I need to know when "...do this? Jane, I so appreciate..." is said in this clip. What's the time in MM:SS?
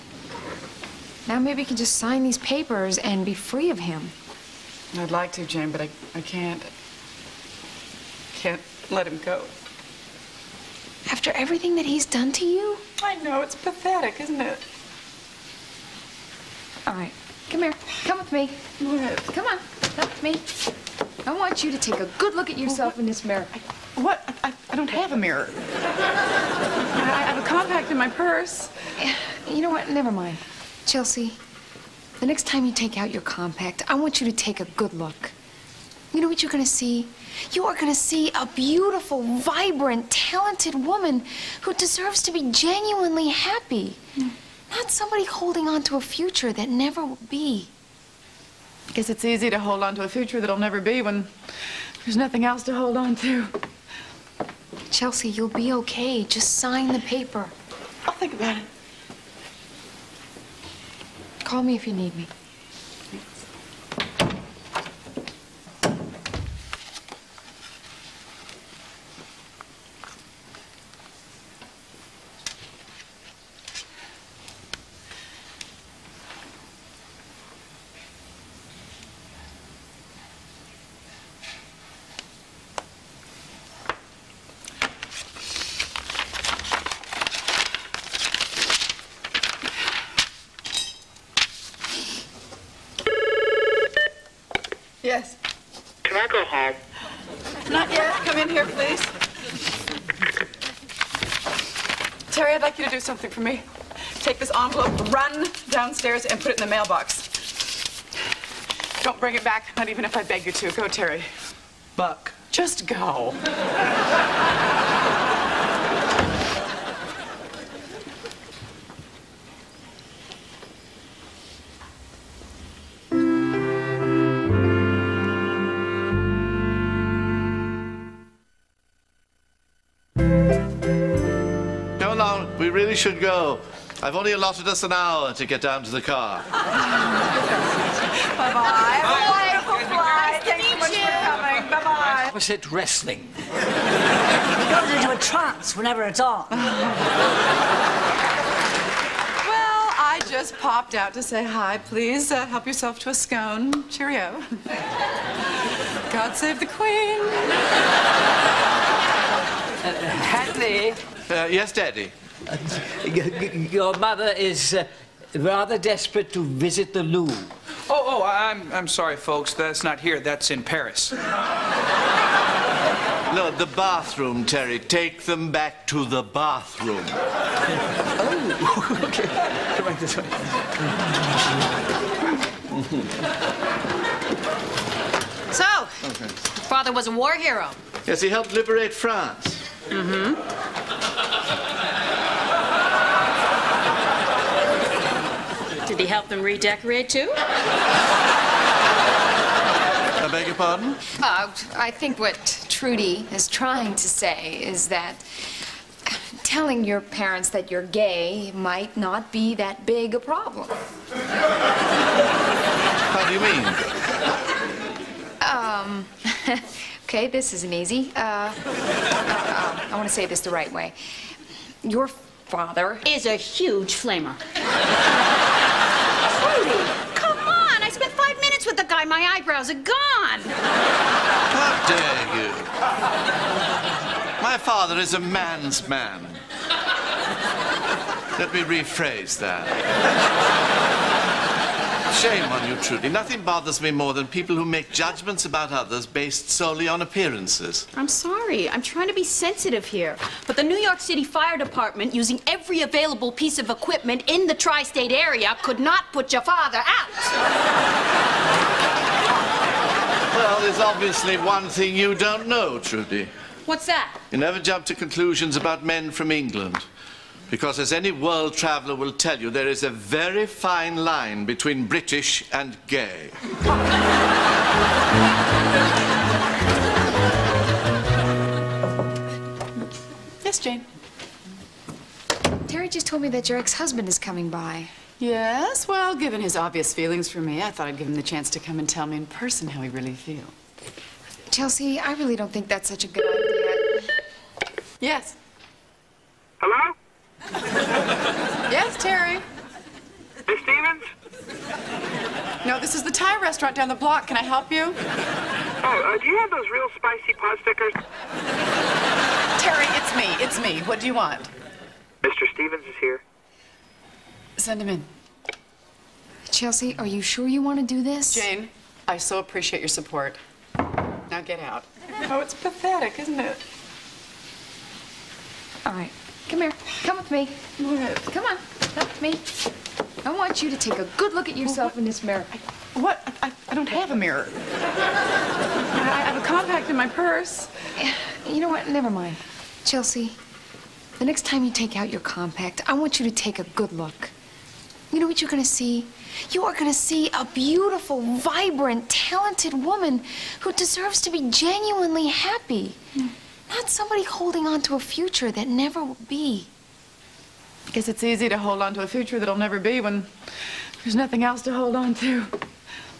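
05:17.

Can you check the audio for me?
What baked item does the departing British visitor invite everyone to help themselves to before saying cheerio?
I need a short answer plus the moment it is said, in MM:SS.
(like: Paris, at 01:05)
a scone, at 02:33.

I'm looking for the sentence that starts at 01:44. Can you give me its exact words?
Take this envelope, run downstairs, and put it in the mailbox.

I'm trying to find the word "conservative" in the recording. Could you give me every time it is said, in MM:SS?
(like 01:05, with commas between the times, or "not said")
not said.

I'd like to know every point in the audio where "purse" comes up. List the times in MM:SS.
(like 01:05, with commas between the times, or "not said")
00:28, 05:37.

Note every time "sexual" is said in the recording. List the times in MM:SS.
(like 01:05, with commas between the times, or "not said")
not said.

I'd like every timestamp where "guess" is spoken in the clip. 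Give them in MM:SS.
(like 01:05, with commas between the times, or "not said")
00:48.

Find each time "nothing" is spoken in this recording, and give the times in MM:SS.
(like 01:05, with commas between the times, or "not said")
00:52, 04:03, 06:01.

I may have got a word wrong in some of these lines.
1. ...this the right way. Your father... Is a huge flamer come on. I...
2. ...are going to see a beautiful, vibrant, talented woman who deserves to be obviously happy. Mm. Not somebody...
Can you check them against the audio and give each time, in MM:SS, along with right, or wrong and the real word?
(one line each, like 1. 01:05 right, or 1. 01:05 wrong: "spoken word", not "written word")
1. 03:40 right
2. 05:46 wrong: "genuinely", not "obviously".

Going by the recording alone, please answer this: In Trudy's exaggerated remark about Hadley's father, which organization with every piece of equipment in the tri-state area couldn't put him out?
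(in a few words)
New York City Fire Department.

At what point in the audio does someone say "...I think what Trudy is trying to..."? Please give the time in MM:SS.
03:21.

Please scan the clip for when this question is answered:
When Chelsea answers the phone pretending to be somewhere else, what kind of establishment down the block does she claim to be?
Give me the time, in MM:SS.
05:03.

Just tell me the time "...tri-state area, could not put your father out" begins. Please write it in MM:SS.
04:14.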